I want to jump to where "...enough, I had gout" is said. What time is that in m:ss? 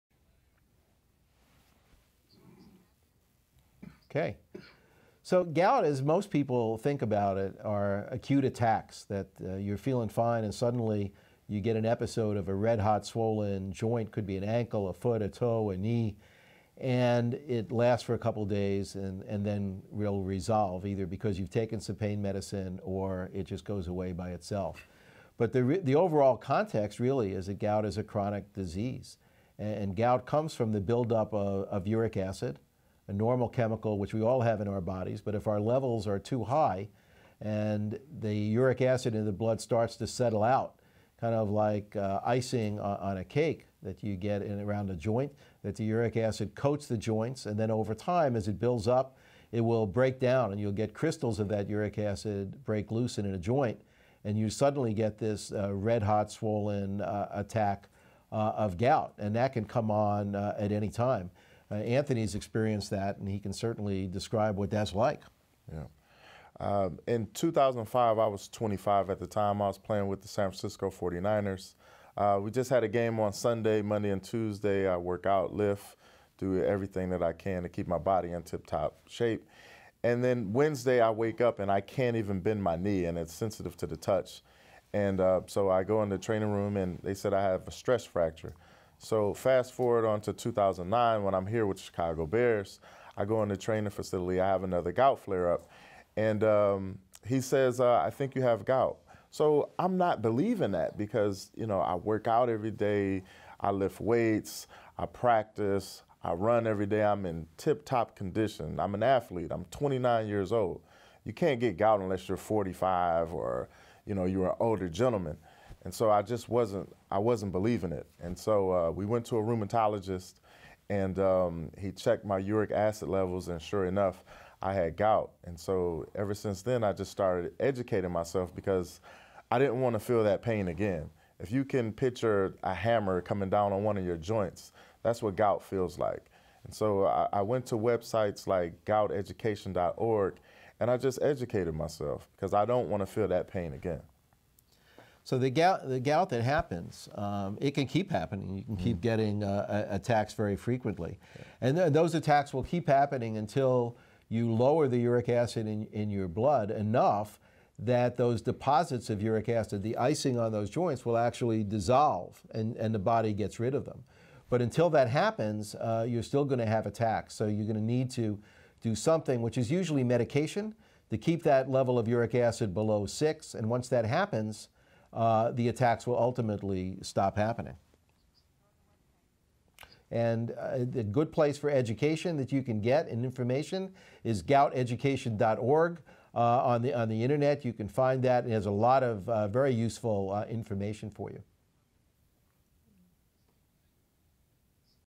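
2:03.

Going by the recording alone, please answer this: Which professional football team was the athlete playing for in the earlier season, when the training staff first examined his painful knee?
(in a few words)
San Francisco 49ers.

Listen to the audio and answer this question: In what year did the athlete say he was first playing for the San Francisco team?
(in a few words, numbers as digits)
2005.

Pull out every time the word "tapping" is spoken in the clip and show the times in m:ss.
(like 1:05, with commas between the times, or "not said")
not said.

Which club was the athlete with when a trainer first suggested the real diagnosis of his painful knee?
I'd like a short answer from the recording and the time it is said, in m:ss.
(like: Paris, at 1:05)
Chicago Bears, at 1:31.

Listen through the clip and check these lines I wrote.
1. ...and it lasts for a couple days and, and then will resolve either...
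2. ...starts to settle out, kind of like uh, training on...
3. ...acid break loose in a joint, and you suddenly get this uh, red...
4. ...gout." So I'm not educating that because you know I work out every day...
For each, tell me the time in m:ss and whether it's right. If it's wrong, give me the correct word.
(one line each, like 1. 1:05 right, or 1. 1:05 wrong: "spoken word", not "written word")
1. 0:16 right
2. 0:39 wrong: "icing", not "training"
3. 0:51 right
4. 1:38 wrong: "believing", not "educating".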